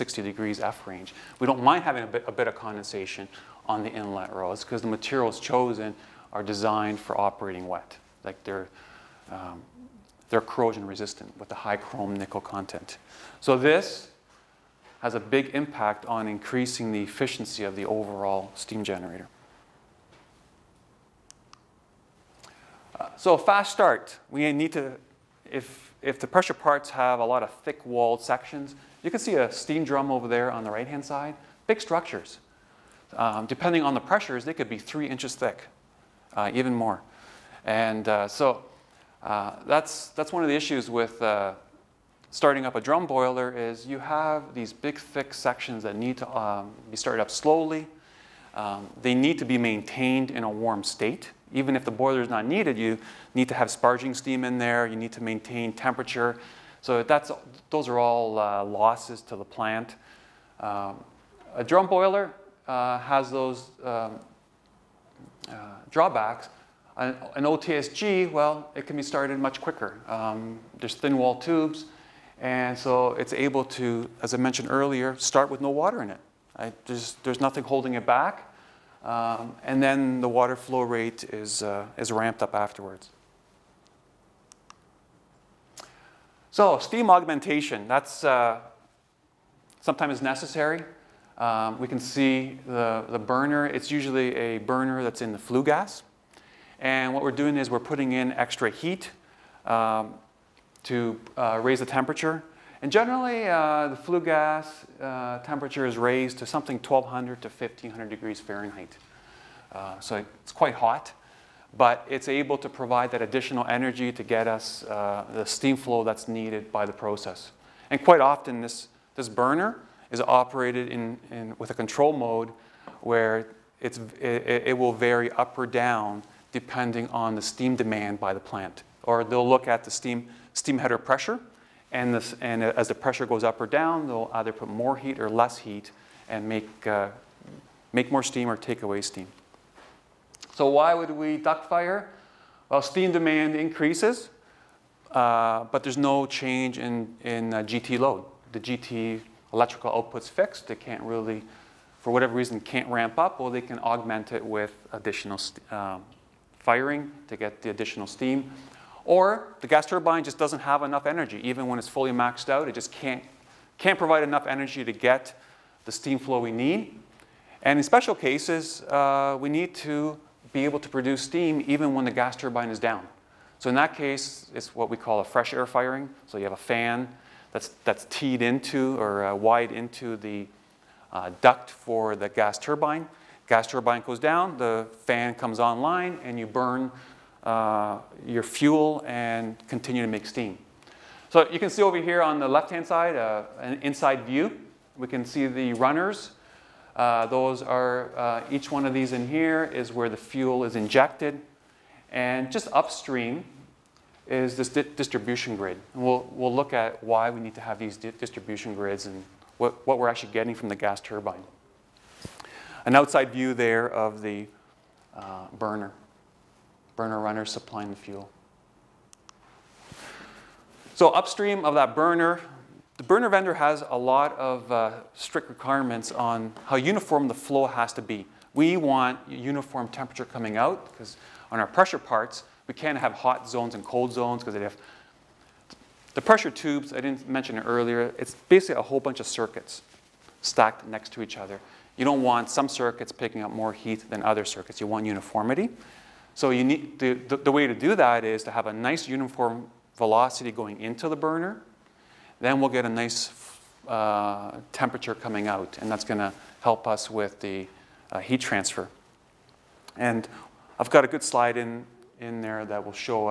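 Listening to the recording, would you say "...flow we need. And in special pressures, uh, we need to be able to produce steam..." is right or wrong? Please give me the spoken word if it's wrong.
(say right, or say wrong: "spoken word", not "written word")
wrong: "cases", not "pressures".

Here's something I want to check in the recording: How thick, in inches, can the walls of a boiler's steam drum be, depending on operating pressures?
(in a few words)
3 inches.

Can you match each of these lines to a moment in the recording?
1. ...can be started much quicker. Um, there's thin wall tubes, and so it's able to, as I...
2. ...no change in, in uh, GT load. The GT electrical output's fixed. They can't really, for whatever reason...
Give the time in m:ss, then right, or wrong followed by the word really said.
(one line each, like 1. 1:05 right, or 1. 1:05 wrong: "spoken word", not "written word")
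1. 1:08 right
2. 2:25 right.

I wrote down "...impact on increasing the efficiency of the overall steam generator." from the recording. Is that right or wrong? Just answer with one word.
right.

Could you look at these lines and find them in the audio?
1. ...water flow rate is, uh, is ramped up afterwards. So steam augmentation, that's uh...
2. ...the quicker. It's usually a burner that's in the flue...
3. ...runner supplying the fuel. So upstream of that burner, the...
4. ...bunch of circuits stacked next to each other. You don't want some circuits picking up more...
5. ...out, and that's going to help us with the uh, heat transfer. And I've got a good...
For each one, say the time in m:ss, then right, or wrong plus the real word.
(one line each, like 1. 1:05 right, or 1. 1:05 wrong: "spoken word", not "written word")
1. 1:20 right
2. 1:33 wrong: "burner", not "quicker"
3. 3:37 right
4. 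3:58 right
5. 4:15 right.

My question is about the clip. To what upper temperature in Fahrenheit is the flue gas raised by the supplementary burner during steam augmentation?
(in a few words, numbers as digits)
1500 degrees Fahrenheit.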